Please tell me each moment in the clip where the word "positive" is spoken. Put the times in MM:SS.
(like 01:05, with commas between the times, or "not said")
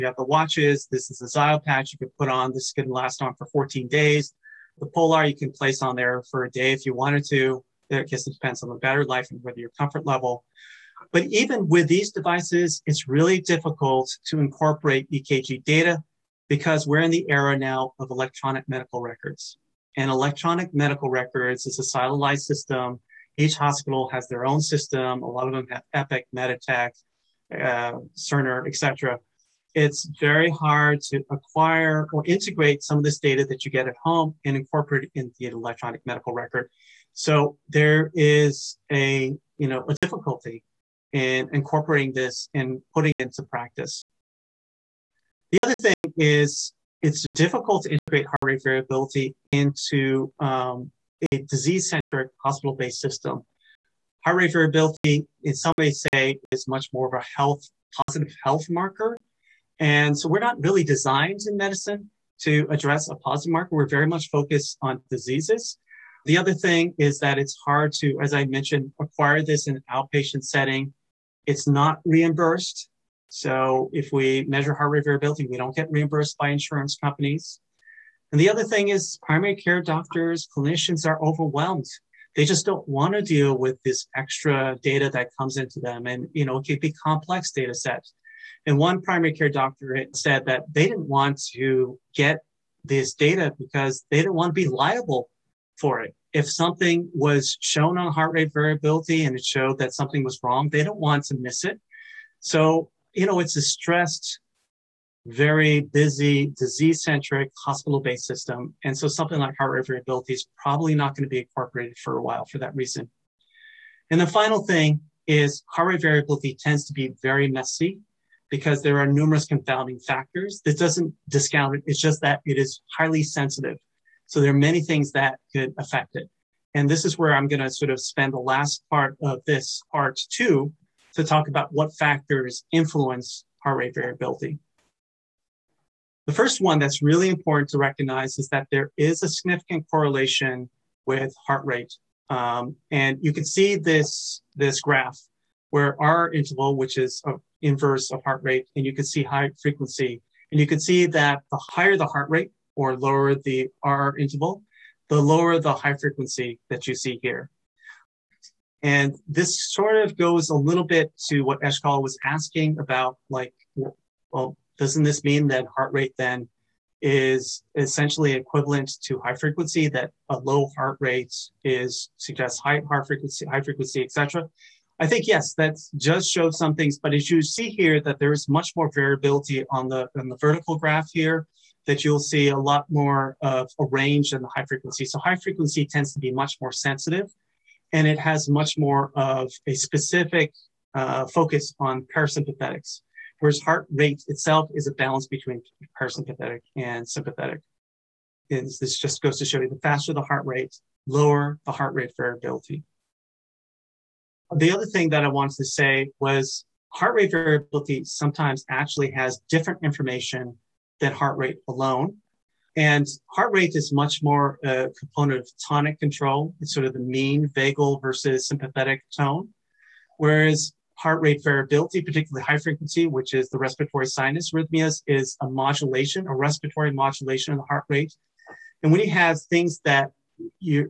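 00:57, 01:03.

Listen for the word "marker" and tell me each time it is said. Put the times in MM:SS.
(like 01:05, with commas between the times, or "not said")
00:58, 01:03.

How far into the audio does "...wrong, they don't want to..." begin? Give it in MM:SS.
01:40.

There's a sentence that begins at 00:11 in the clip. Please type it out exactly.
But even with these devices, it's really difficult to incorporate EKG data because we're in the era now of electronic medical records.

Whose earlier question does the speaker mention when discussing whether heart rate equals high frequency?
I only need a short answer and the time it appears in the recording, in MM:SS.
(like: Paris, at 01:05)
Eshkol, at 02:41.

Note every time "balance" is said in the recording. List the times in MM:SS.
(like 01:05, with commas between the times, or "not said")
03:14.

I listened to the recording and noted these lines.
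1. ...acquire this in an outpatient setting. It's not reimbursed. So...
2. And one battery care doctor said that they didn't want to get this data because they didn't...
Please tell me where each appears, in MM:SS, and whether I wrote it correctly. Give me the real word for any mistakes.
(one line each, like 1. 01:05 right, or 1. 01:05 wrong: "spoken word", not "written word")
1. 01:08 right
2. 01:28 wrong: "primary", not "battery".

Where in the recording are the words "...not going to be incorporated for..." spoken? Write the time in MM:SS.
01:50.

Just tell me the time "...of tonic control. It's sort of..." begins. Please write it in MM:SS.
03:35.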